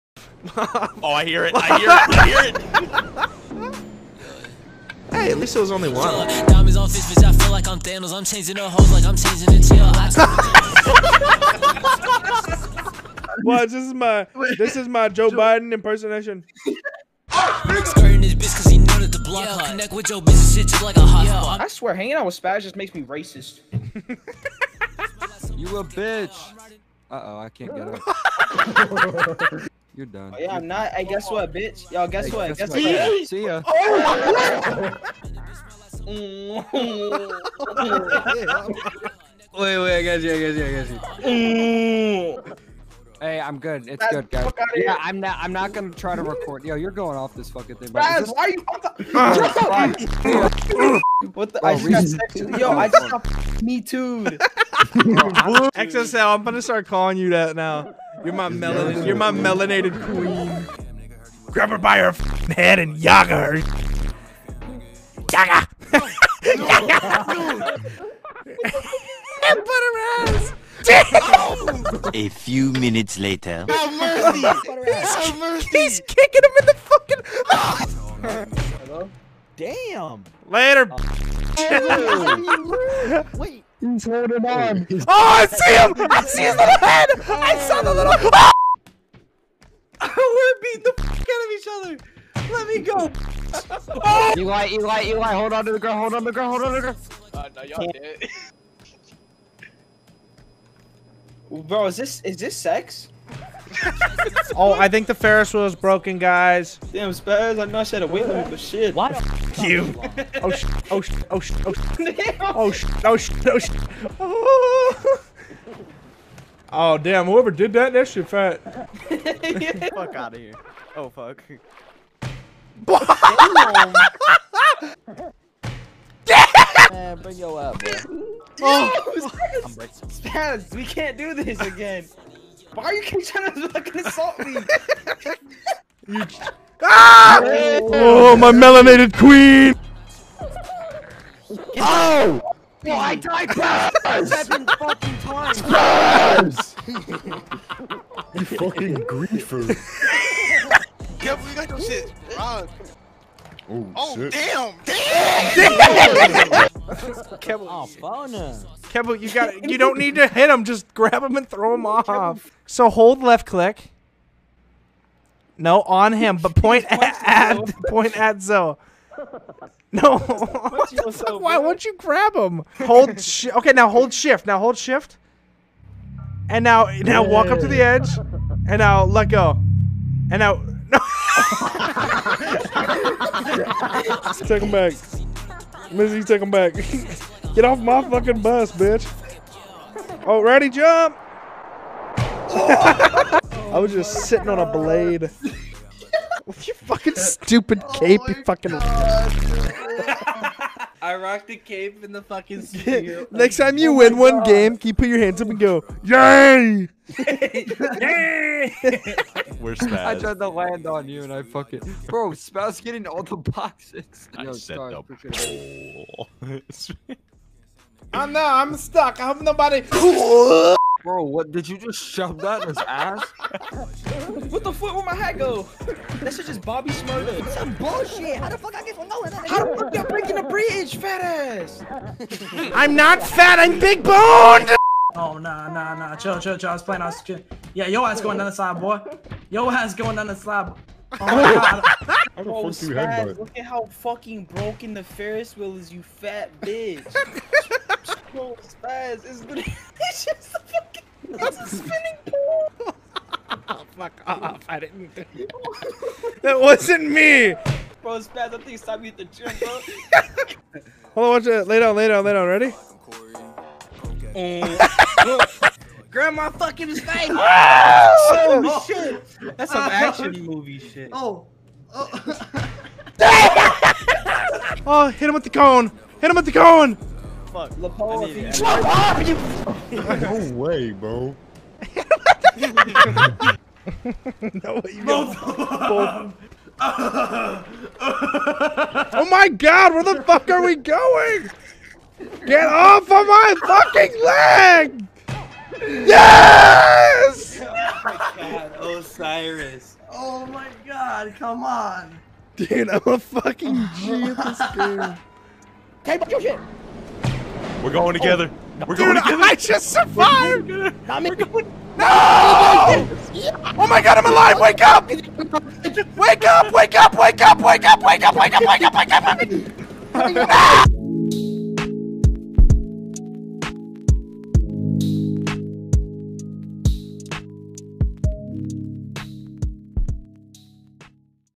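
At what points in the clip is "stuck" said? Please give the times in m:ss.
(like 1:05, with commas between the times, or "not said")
3:38.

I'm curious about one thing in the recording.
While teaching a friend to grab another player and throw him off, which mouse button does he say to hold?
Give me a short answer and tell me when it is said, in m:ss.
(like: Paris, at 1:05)
left click, at 2:43.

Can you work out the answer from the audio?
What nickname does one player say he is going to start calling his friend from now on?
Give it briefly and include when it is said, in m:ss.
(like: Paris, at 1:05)
XSL, at 0:54.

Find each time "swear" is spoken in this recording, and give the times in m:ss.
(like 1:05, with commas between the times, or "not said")
0:21.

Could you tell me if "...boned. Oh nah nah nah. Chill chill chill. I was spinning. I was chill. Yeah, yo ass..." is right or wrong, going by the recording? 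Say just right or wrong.
wrong.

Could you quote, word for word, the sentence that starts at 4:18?
Bro, Spaz, I think it's time me at the gym, bro.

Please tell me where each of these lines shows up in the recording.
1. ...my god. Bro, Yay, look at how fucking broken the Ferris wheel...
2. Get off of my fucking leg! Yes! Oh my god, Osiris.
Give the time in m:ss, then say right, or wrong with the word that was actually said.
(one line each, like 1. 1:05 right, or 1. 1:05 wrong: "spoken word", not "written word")
1. 4:01 wrong: "Spaz", not "Yay"
2. 4:52 right.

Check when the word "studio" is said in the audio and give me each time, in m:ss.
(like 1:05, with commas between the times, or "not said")
3:22.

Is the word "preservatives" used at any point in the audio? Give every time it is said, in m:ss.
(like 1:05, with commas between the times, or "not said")
not said.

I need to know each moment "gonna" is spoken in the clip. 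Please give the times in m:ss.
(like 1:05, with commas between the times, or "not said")
0:45, 0:56.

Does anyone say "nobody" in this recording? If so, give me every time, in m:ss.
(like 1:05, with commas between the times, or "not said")
3:39.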